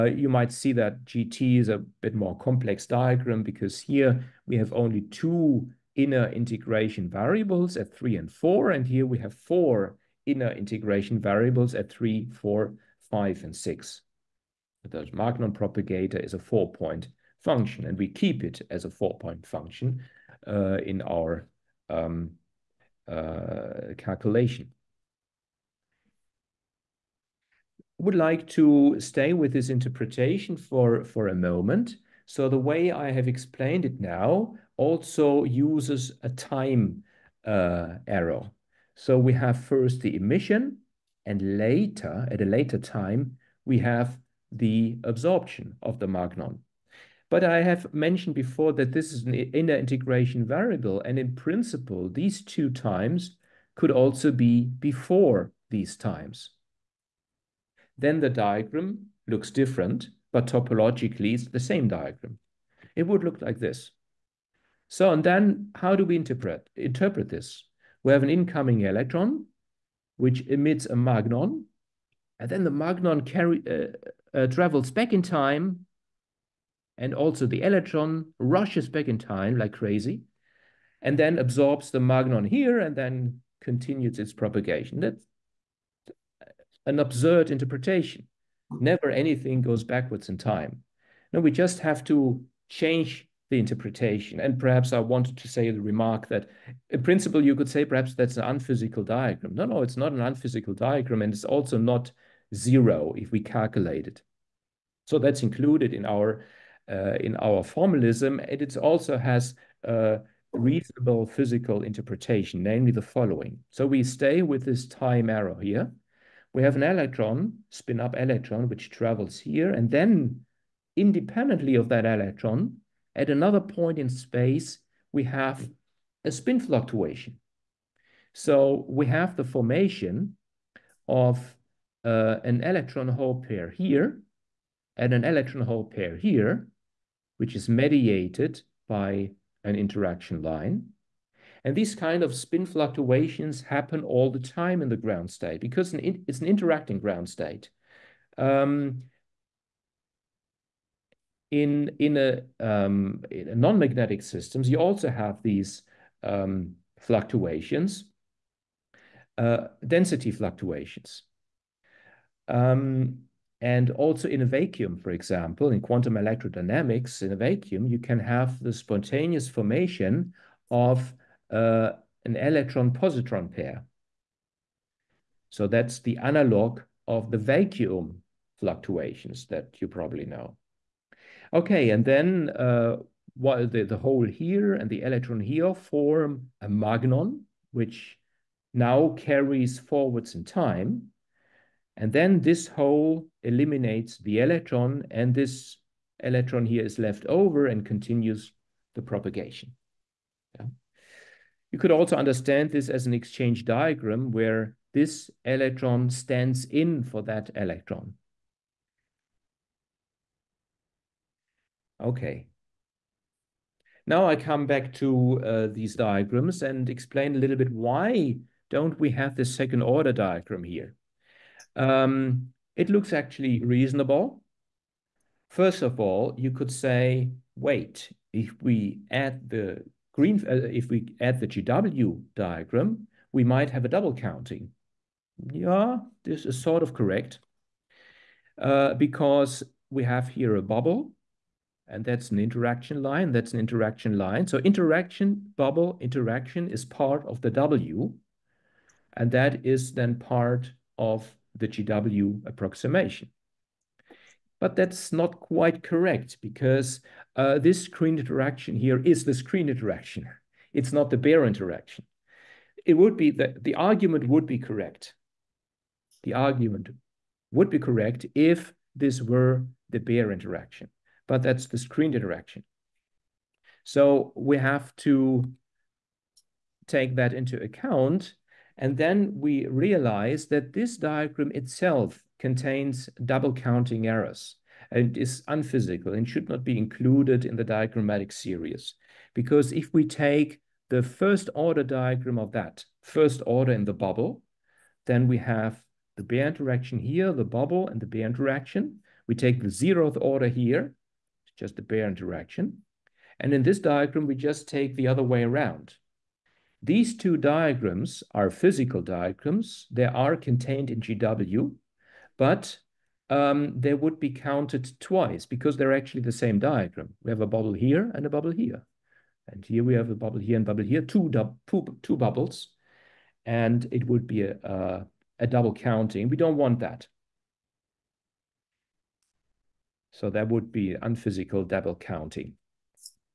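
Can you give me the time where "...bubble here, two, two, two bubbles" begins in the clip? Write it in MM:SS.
05:20.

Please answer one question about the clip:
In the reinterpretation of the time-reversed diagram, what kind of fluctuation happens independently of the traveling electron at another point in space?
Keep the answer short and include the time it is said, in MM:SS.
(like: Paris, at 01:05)
spin fluctuation, at 02:06.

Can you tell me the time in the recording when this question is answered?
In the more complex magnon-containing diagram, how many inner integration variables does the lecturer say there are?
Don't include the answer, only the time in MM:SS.
00:09.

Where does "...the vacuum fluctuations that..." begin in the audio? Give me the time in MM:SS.
02:57.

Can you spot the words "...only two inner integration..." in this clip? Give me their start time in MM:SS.
00:04.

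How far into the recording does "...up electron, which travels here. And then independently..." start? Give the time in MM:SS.
01:58.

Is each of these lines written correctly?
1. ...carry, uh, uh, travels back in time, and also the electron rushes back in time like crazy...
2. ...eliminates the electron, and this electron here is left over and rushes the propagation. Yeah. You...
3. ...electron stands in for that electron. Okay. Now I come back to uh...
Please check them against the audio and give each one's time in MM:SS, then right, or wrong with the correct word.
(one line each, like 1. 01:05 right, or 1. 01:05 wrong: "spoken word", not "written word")
1. 01:13 right
2. 03:13 wrong: "continues", not "rushes"
3. 03:25 right.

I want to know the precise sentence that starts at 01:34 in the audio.
And perhaps I wanted to say the remark that in principle, you could say perhaps that's an unphysical diagram.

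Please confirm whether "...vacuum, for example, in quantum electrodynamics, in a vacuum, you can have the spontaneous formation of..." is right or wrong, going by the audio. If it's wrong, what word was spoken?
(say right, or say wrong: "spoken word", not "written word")
right.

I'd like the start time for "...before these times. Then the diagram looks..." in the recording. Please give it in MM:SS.
00:54.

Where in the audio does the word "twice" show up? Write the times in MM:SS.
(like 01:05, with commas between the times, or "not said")
05:15.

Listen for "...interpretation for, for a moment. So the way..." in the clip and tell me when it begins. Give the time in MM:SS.
00:29.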